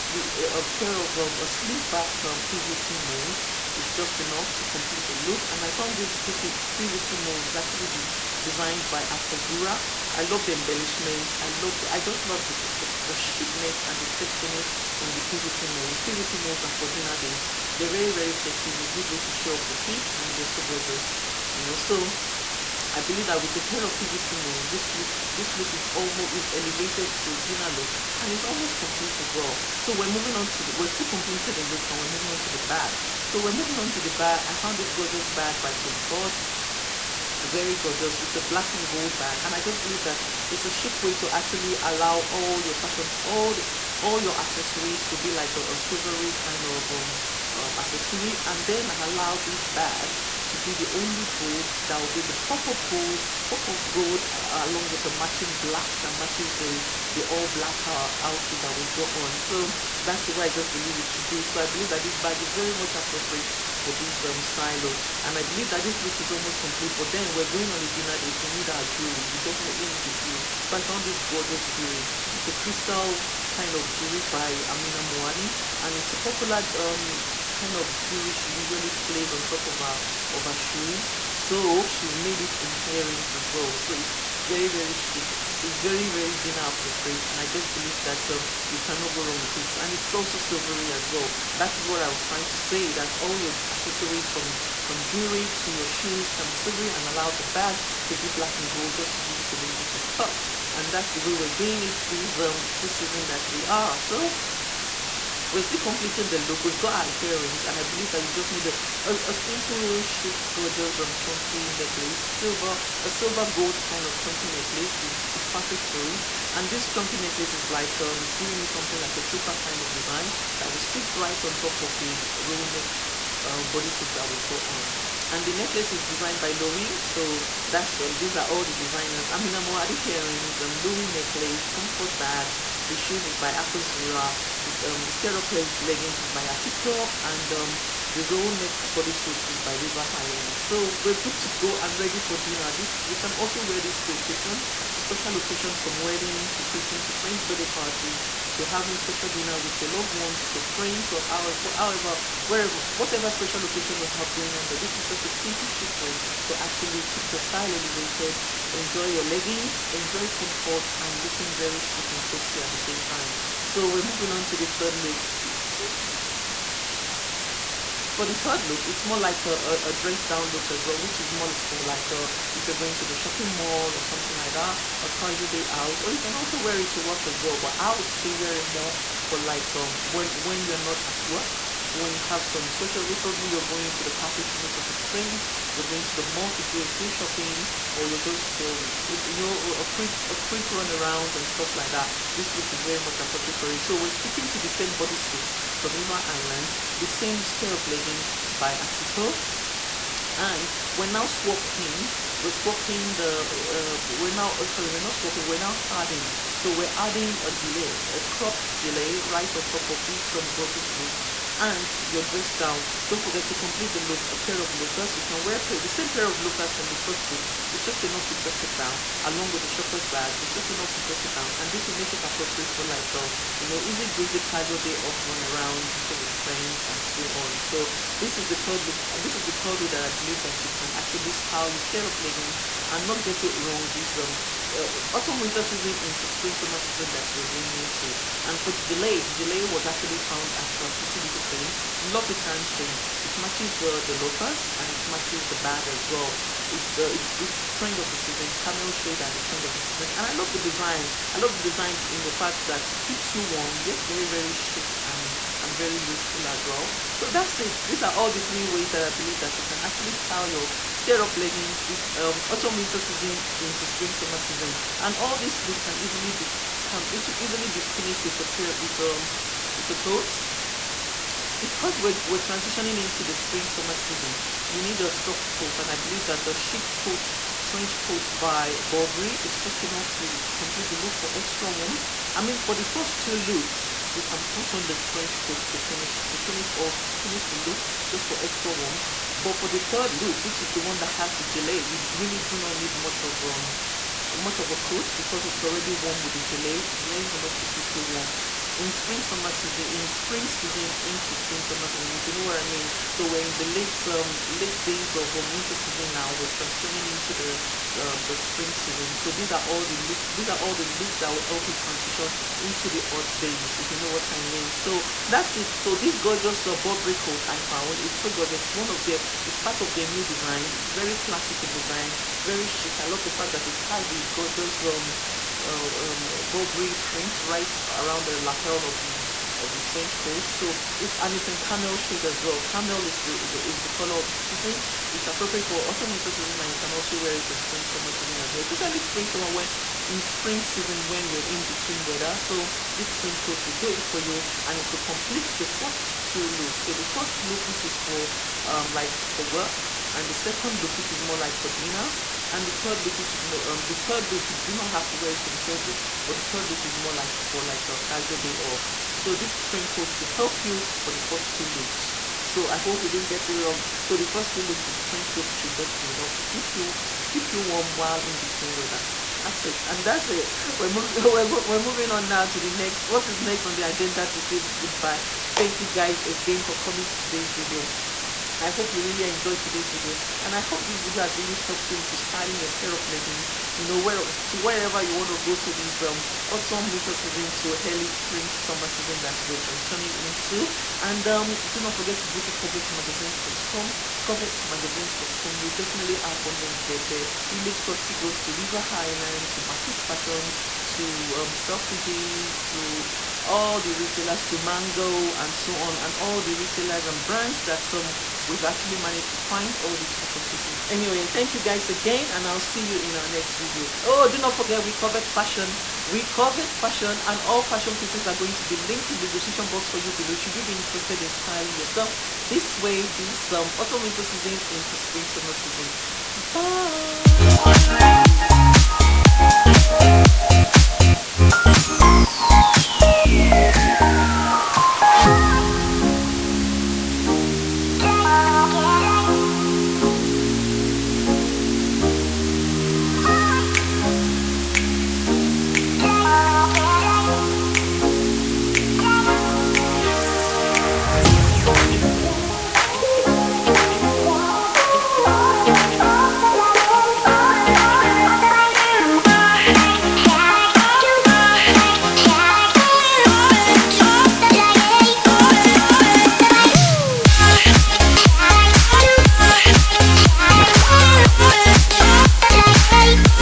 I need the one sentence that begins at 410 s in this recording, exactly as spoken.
Anyway, thank you guys again and I'll see you in our next video.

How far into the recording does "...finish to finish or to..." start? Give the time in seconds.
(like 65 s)
285 s.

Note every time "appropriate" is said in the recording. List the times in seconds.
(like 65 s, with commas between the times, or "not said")
62 s, 86 s, 193 s, 222 s, 335 s.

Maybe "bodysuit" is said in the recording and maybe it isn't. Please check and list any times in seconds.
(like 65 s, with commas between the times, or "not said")
123 s, 138 s, 194 s.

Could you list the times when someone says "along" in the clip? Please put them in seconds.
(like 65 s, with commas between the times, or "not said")
54 s, 219 s.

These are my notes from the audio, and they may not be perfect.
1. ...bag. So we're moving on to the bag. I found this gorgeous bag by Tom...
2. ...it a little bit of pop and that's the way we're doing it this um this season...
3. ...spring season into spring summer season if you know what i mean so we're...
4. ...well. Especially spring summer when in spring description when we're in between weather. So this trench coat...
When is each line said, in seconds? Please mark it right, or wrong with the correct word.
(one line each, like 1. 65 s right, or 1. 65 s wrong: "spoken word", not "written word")
1. 32 s right
2. 99 s right
3. 300 s right
4. 338 s wrong: "season", not "description".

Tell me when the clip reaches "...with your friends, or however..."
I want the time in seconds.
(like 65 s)
150 s.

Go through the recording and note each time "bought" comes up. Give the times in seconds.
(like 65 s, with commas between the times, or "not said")
not said.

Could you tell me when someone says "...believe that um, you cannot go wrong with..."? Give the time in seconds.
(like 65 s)
87 s.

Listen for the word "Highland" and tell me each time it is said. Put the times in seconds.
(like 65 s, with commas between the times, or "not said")
140 s, 398 s.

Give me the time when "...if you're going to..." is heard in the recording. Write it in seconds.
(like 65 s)
172 s.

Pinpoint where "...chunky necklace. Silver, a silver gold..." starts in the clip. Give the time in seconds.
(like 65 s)
111 s.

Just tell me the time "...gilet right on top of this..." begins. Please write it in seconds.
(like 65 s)
208 s.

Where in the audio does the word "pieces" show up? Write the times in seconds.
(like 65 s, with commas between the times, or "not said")
410 s, 417 s.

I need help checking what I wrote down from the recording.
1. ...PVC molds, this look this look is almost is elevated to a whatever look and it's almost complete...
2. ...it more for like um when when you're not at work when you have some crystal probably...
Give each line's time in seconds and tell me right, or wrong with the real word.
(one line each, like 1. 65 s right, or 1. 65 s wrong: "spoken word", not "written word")
1. 23 s wrong: "dinner", not "whatever"
2. 178 s wrong: "special", not "crystal".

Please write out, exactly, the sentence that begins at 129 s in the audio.
I I'm mean, Amina Muaddi earrings, um, Louis necklace, Tom Ford bag.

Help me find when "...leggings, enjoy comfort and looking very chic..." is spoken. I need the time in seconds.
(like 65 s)
159 s.